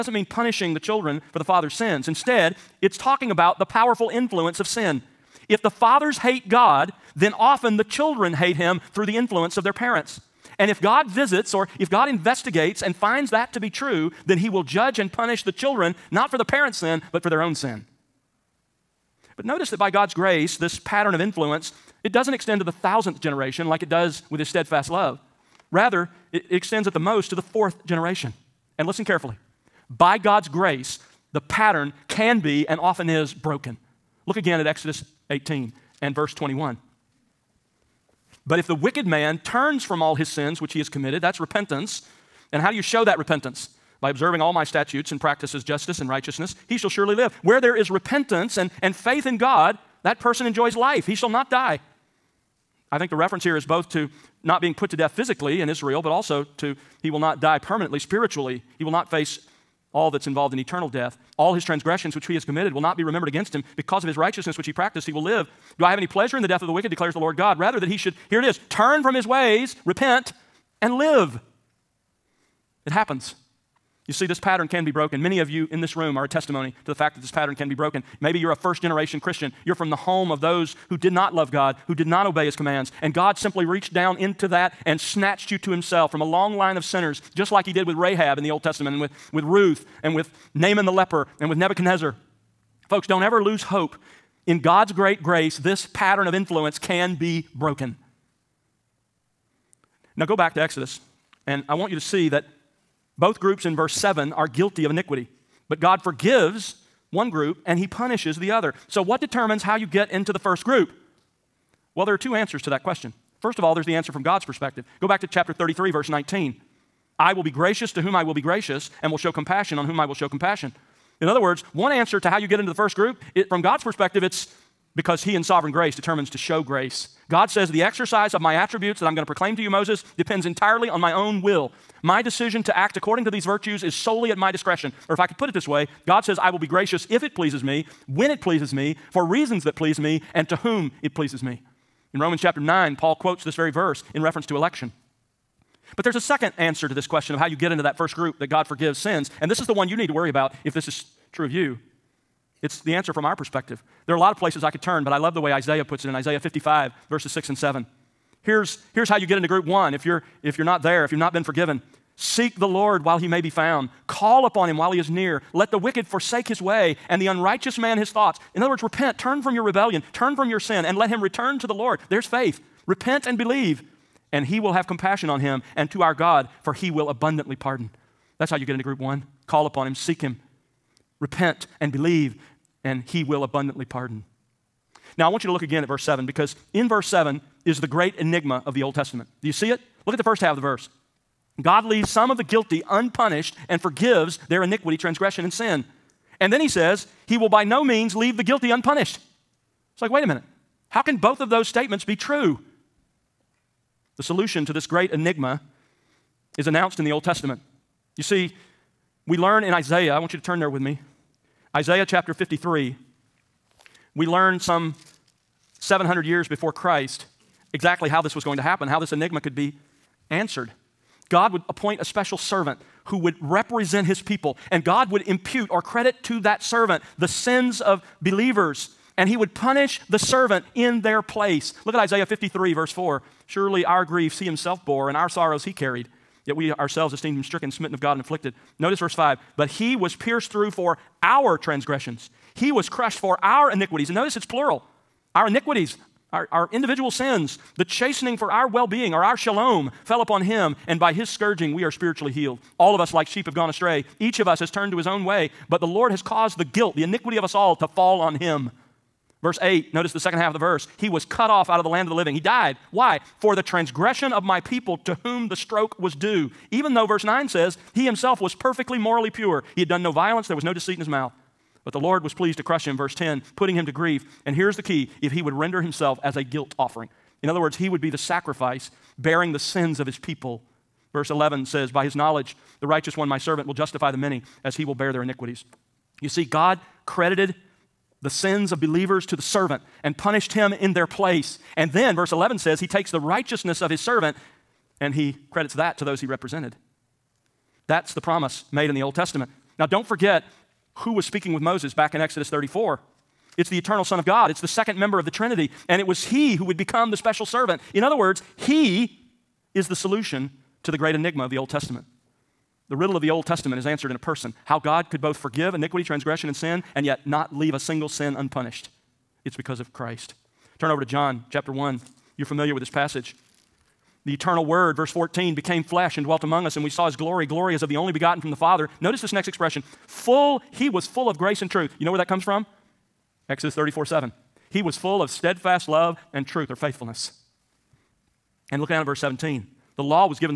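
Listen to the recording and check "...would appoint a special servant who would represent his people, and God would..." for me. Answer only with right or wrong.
right.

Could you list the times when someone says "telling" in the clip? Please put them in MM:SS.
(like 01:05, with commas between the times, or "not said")
not said.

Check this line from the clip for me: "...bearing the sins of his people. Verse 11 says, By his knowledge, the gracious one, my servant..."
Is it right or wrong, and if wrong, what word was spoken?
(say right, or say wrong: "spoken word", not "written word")
wrong: "righteous", not "gracious".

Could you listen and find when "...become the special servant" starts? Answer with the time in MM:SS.
05:06.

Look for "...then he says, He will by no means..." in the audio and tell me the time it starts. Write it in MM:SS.
03:16.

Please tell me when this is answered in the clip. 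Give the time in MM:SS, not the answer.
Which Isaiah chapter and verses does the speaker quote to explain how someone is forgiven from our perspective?
02:36.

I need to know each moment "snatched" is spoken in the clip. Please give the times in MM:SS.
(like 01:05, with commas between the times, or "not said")
01:24.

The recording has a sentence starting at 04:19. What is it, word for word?
Verse 8, notice the second half of the verse.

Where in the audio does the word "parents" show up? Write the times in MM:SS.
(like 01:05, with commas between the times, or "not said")
00:09, 00:16.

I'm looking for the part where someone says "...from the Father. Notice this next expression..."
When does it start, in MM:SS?
05:28.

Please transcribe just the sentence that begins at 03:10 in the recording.
Look at the first half of the verse.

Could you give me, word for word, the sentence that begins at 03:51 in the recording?
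Look at Isaiah 53, verse 4.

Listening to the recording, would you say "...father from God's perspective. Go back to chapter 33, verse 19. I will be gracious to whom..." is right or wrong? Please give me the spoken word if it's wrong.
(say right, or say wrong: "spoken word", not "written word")
wrong: "answer", not "father".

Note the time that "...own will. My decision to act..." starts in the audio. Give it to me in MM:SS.
02:11.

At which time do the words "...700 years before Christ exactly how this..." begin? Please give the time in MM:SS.
03:35.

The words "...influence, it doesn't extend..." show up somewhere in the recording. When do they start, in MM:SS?
00:21.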